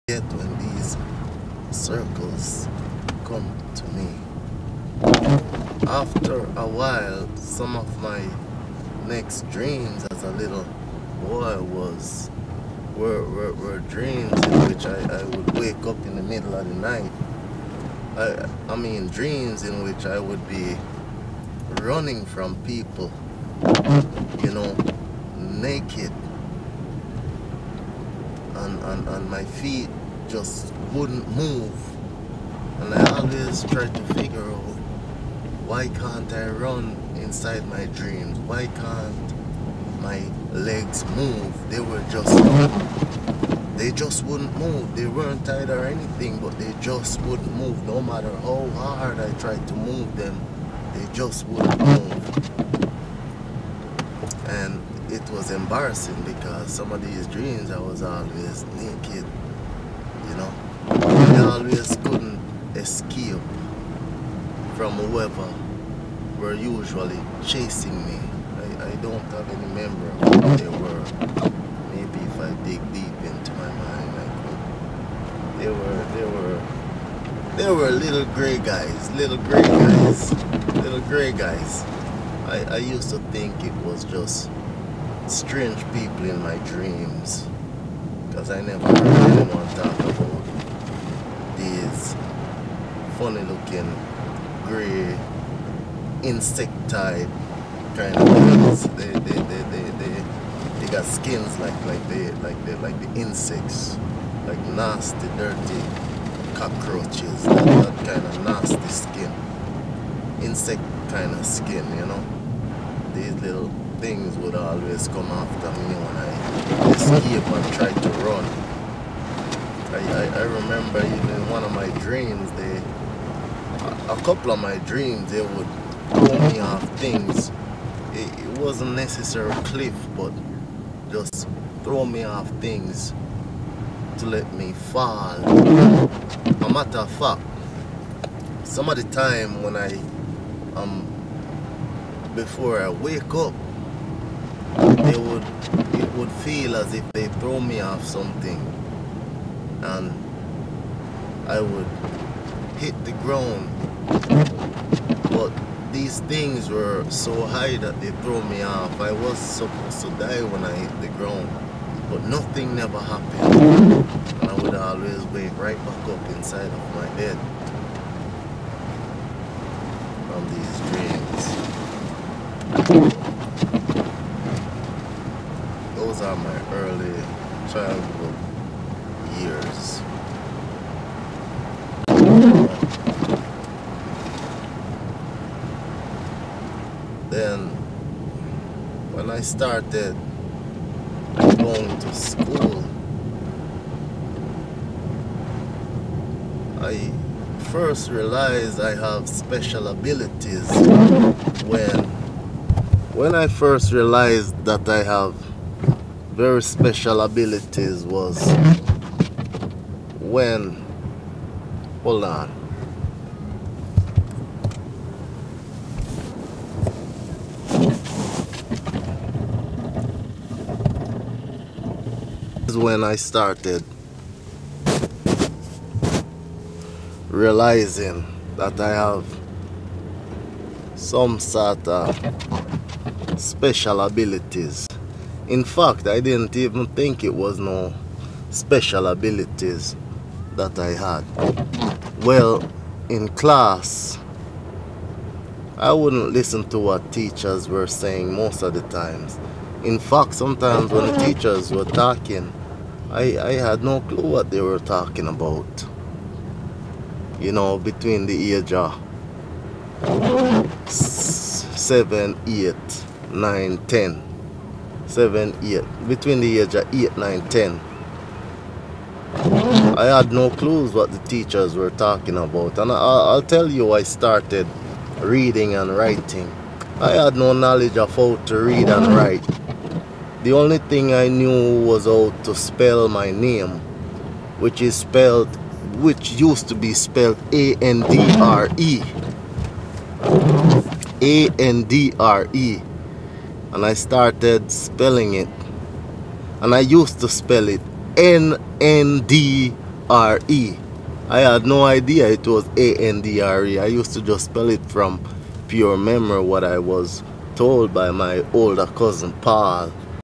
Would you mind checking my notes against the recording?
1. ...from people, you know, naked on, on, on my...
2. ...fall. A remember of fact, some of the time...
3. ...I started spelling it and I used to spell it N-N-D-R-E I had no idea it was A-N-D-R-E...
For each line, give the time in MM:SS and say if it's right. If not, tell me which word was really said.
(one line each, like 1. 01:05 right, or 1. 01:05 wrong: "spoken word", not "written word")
1. 00:22 right
2. 02:14 wrong: "matter", not "remember"
3. 04:53 right.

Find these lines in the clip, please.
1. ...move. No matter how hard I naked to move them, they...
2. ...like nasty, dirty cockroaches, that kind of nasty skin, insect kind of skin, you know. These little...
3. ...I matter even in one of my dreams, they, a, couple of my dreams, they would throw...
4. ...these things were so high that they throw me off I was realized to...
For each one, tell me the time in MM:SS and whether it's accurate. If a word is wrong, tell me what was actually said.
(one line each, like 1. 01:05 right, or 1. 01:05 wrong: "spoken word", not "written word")
1. 00:47 wrong: "tried", not "naked"
2. 01:44 right
3. 02:00 wrong: "remember", not "matter"
4. 02:35 wrong: "supposed", not "realized".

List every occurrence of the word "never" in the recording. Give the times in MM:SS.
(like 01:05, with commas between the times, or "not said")
01:28, 02:42.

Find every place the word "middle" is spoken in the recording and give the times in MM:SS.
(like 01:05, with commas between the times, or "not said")
00:16.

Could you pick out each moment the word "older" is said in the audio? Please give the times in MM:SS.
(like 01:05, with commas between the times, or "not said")
05:08.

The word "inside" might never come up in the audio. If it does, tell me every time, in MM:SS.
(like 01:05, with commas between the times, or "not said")
00:37, 02:46.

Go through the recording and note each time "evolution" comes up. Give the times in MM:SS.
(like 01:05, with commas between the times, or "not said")
not said.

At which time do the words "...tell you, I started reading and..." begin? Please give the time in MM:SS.
04:33.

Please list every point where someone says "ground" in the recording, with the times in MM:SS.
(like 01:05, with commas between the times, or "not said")
02:33, 02:41.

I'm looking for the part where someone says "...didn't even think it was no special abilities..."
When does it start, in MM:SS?
03:56.